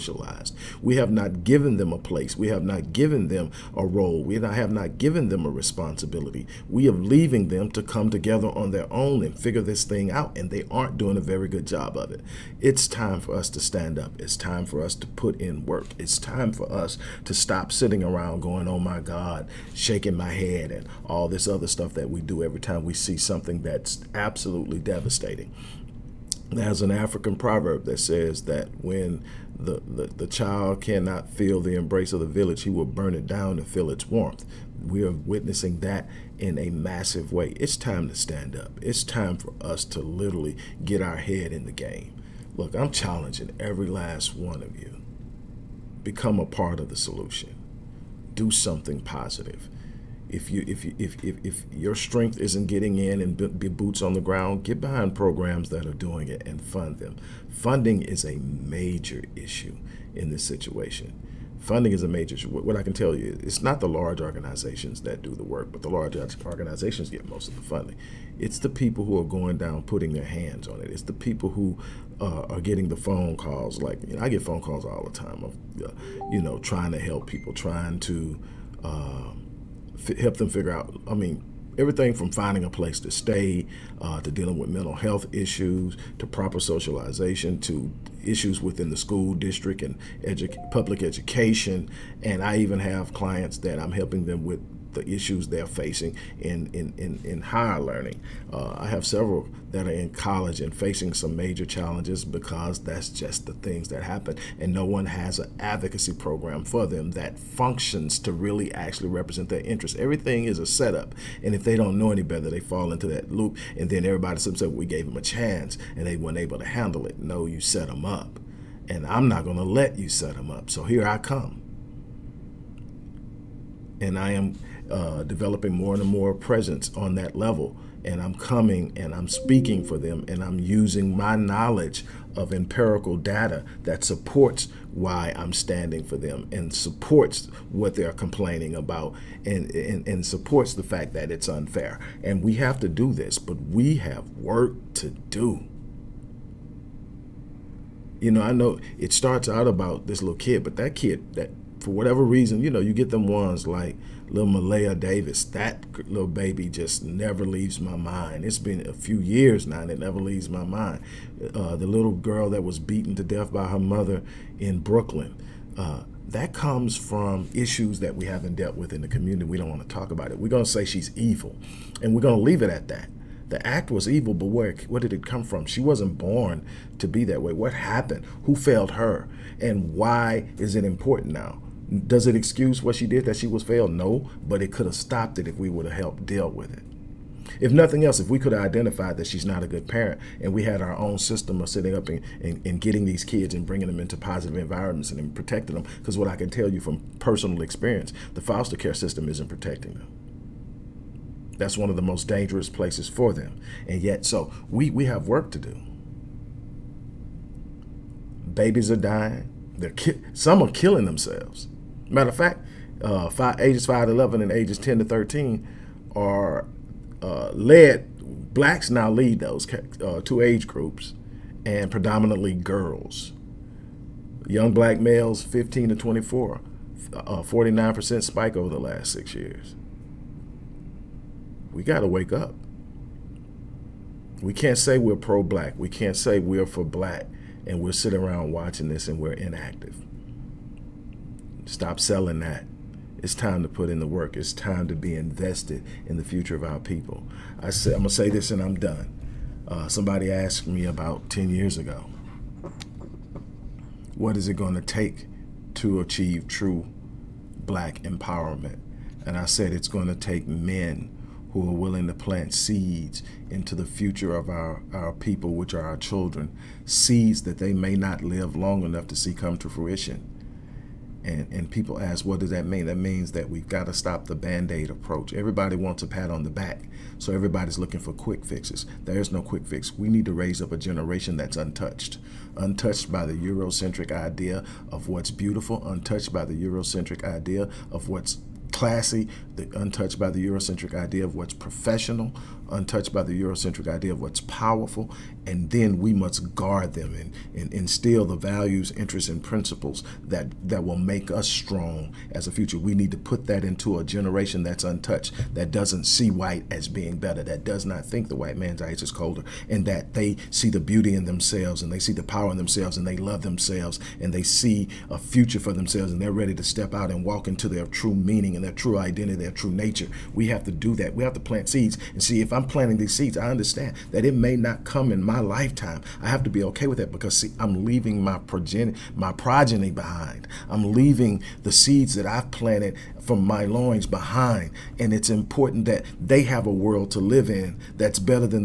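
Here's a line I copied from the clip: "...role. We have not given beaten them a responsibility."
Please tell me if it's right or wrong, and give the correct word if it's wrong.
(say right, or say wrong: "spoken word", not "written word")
wrong: "given", not "beaten".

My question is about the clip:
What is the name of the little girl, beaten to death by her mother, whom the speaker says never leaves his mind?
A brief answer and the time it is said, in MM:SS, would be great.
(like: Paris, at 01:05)
Malaya Davis, at 02:34.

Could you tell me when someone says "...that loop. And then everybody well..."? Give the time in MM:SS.
01:53.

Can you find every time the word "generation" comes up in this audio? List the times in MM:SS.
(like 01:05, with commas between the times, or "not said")
04:40, 05:04.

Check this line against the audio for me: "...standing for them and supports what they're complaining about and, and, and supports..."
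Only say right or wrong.
right.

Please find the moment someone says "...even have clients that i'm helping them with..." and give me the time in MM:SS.
01:32.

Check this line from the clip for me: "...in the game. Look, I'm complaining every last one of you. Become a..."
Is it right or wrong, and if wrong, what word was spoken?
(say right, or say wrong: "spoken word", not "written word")
wrong: "challenging", not "complaining".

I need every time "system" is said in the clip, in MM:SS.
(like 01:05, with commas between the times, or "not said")
03:11, 03:18.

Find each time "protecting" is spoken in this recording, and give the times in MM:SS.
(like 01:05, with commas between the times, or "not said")
03:15, 03:19.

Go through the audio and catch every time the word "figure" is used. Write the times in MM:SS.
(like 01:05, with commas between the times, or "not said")
00:09, 01:20.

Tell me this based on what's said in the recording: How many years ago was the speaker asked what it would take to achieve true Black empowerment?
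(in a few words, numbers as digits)
10 years.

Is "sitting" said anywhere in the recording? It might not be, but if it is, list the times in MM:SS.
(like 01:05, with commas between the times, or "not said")
00:17, 03:57.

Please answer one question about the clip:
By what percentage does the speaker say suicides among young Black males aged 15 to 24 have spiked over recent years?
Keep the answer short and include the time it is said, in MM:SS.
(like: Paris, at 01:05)
49%, at 03:47.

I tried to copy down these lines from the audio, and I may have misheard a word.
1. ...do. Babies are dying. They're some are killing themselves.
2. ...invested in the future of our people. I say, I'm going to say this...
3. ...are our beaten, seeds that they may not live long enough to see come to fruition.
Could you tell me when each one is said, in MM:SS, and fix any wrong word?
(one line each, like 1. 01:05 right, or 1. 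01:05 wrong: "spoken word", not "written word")
1. 03:25 right
2. 04:05 right
3. 04:25 wrong: "children", not "beaten".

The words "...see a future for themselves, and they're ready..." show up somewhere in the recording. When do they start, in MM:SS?
05:14.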